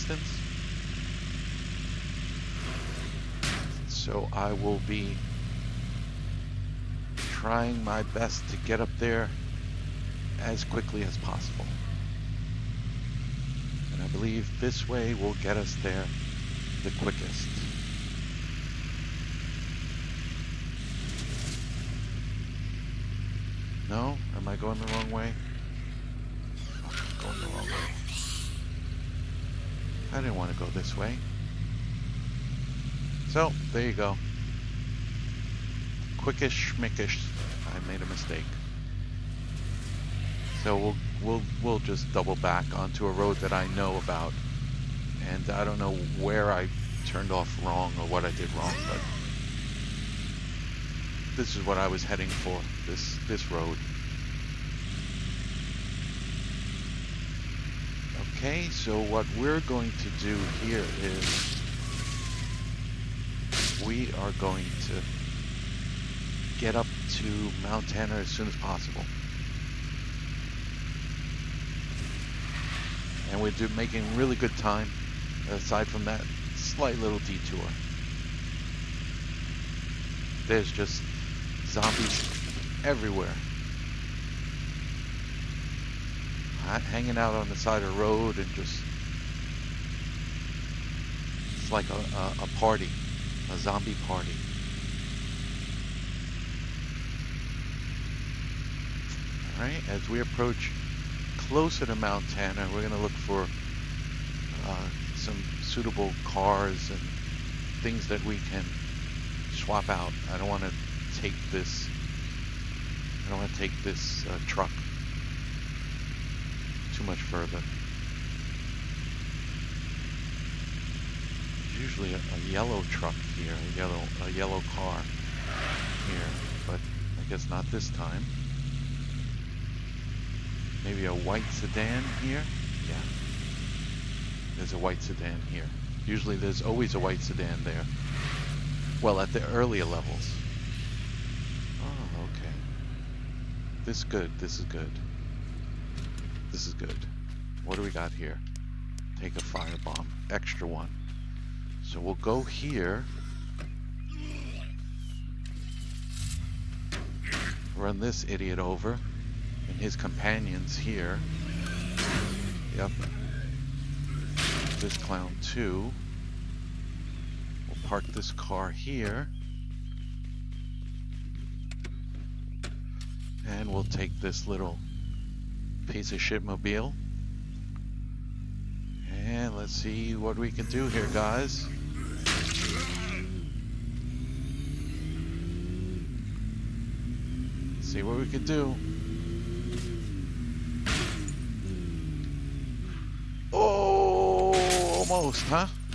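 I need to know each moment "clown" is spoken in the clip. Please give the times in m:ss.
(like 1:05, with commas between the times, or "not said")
2:44.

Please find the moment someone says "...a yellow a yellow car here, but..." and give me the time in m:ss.
2:03.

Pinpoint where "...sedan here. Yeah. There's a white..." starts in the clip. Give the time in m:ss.
2:11.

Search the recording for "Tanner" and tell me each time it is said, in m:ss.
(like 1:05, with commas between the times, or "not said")
1:07, 1:42.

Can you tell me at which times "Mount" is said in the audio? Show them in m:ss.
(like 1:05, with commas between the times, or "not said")
1:07, 1:41.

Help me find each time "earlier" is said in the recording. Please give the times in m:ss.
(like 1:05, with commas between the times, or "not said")
2:19.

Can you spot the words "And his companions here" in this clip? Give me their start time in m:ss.
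2:39.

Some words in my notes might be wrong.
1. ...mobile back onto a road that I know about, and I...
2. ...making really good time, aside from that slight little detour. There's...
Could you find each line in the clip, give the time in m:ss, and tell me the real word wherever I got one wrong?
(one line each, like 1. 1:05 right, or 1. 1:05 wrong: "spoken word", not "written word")
1. 0:42 wrong: "double", not "mobile"
2. 1:13 right.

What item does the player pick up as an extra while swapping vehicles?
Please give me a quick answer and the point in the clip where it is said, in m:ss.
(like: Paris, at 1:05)
Firebomb, at 2:29.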